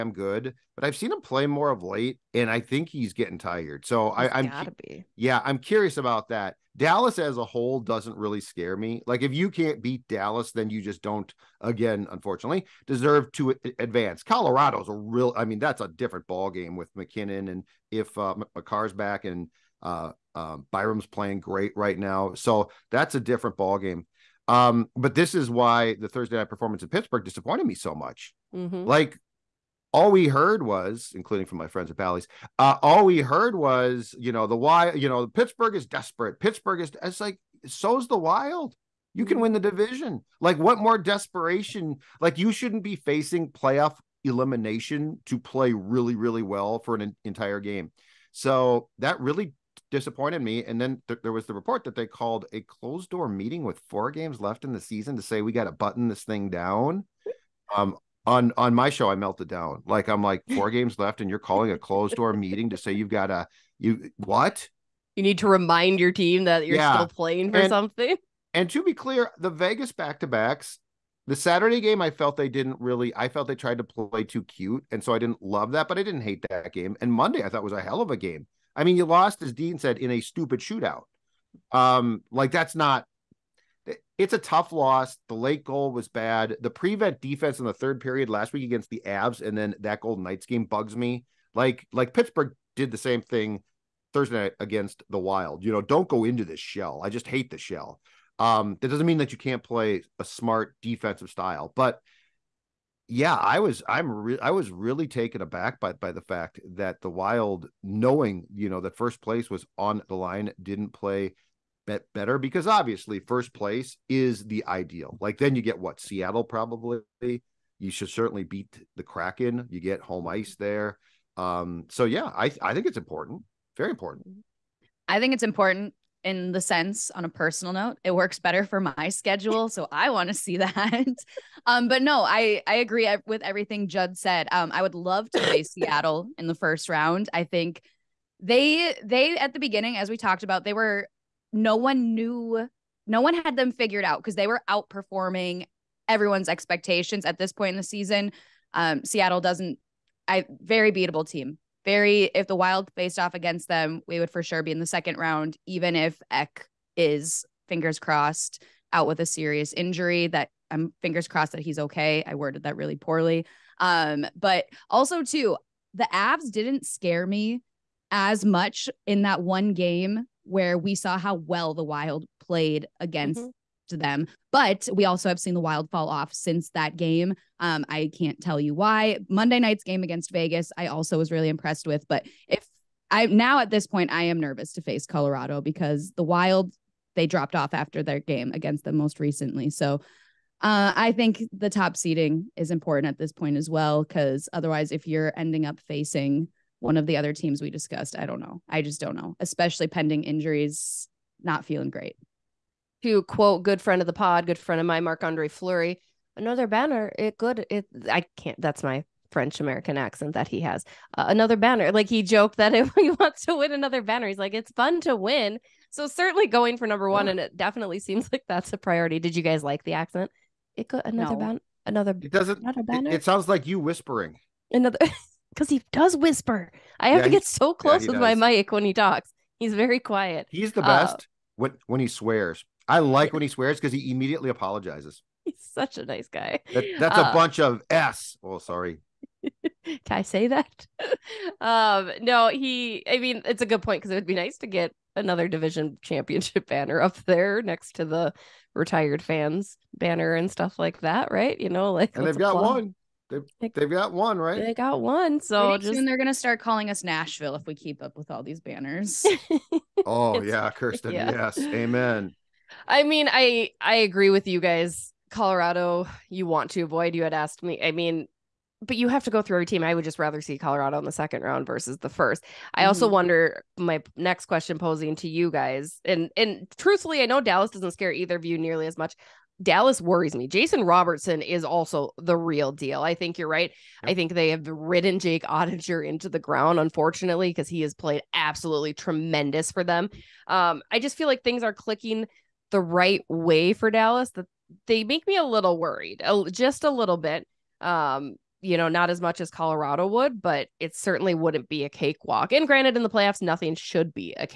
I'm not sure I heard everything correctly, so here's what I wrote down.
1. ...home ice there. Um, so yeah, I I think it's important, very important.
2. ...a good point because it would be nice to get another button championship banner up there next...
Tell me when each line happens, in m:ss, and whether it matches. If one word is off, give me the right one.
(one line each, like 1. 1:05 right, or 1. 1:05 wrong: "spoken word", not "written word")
1. 2:00 right
2. 4:03 wrong: "division", not "button".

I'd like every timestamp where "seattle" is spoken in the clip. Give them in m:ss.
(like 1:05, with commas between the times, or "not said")
1:56, 2:15, 2:29.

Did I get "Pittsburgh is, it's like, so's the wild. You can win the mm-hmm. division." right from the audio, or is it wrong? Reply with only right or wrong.
right.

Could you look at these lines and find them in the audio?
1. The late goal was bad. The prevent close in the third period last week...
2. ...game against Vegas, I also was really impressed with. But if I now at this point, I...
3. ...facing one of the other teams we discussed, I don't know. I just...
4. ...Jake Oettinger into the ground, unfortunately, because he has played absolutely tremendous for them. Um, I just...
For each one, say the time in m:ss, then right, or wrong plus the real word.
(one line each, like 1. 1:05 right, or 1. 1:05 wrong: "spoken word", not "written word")
1. 1:25 wrong: "defense", not "close"
2. 2:59 right
3. 3:15 right
4. 4:45 right.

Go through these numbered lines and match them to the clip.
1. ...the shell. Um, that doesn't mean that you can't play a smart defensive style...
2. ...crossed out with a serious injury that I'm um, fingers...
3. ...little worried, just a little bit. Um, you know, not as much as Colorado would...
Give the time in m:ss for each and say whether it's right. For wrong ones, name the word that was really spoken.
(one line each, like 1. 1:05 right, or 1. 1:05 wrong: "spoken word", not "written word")
1. 1:37 right
2. 2:37 right
3. 4:55 right.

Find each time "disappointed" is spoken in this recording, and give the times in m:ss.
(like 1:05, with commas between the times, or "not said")
0:27, 0:49.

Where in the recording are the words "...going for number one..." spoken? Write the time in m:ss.
3:36.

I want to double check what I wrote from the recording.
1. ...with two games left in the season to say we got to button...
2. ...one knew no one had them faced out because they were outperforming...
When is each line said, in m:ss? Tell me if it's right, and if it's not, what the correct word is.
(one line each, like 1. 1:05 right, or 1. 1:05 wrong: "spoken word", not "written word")
1. 0:53 wrong: "four", not "two"
2. 2:21 wrong: "figured", not "faced".